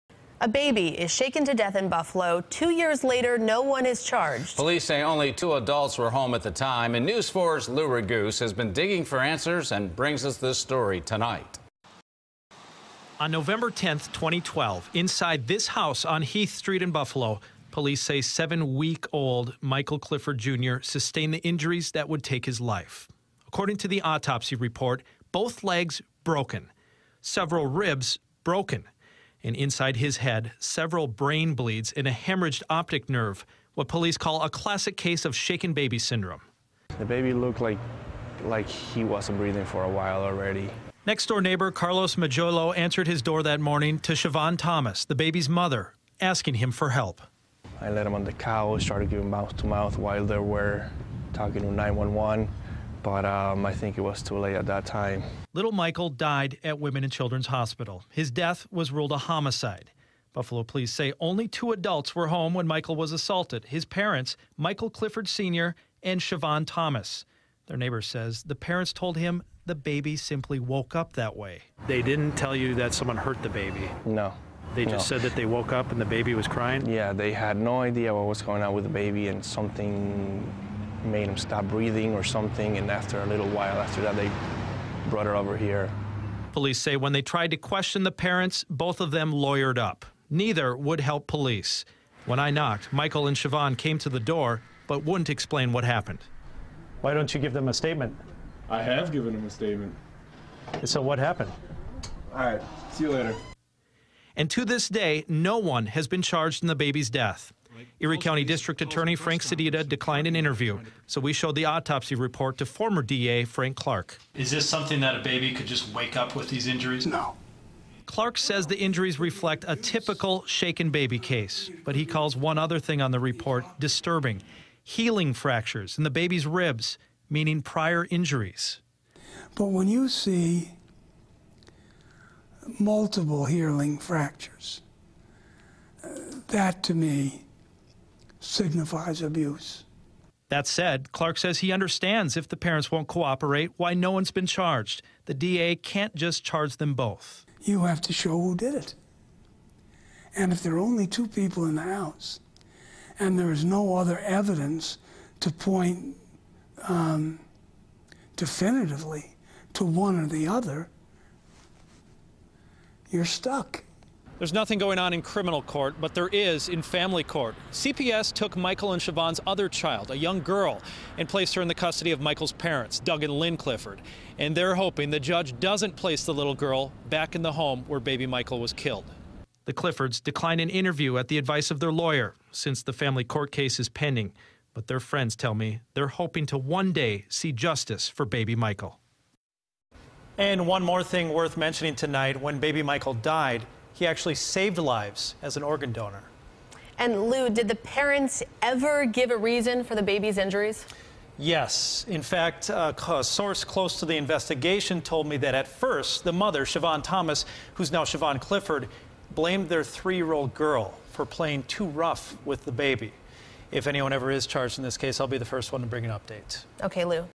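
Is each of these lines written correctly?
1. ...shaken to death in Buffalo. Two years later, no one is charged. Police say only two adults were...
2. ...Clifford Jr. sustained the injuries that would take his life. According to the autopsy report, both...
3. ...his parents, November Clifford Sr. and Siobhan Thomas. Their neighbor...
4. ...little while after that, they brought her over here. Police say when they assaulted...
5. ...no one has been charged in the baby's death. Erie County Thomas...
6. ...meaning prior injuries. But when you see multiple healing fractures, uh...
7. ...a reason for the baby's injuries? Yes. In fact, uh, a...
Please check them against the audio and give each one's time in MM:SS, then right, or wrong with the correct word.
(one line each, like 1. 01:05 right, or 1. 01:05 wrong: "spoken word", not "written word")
1. 00:01 right
2. 00:19 right
3. 01:03 wrong: "Michael", not "November"
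4. 01:23 wrong: "tried", not "assaulted"
5. 01:45 wrong: "District", not "Thomas"
6. 02:07 right
7. 03:19 right.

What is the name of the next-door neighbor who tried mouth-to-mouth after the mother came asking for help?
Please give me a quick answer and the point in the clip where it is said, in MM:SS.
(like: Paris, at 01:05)
Carlos Majolo, at 00:41.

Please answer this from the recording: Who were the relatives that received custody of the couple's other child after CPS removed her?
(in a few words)
Doug and Lynn Clifford.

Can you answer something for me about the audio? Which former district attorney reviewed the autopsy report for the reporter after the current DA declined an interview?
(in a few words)
Frank Clark.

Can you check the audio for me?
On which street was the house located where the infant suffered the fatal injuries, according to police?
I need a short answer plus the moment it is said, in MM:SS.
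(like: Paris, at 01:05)
Heath Street, at 00:16.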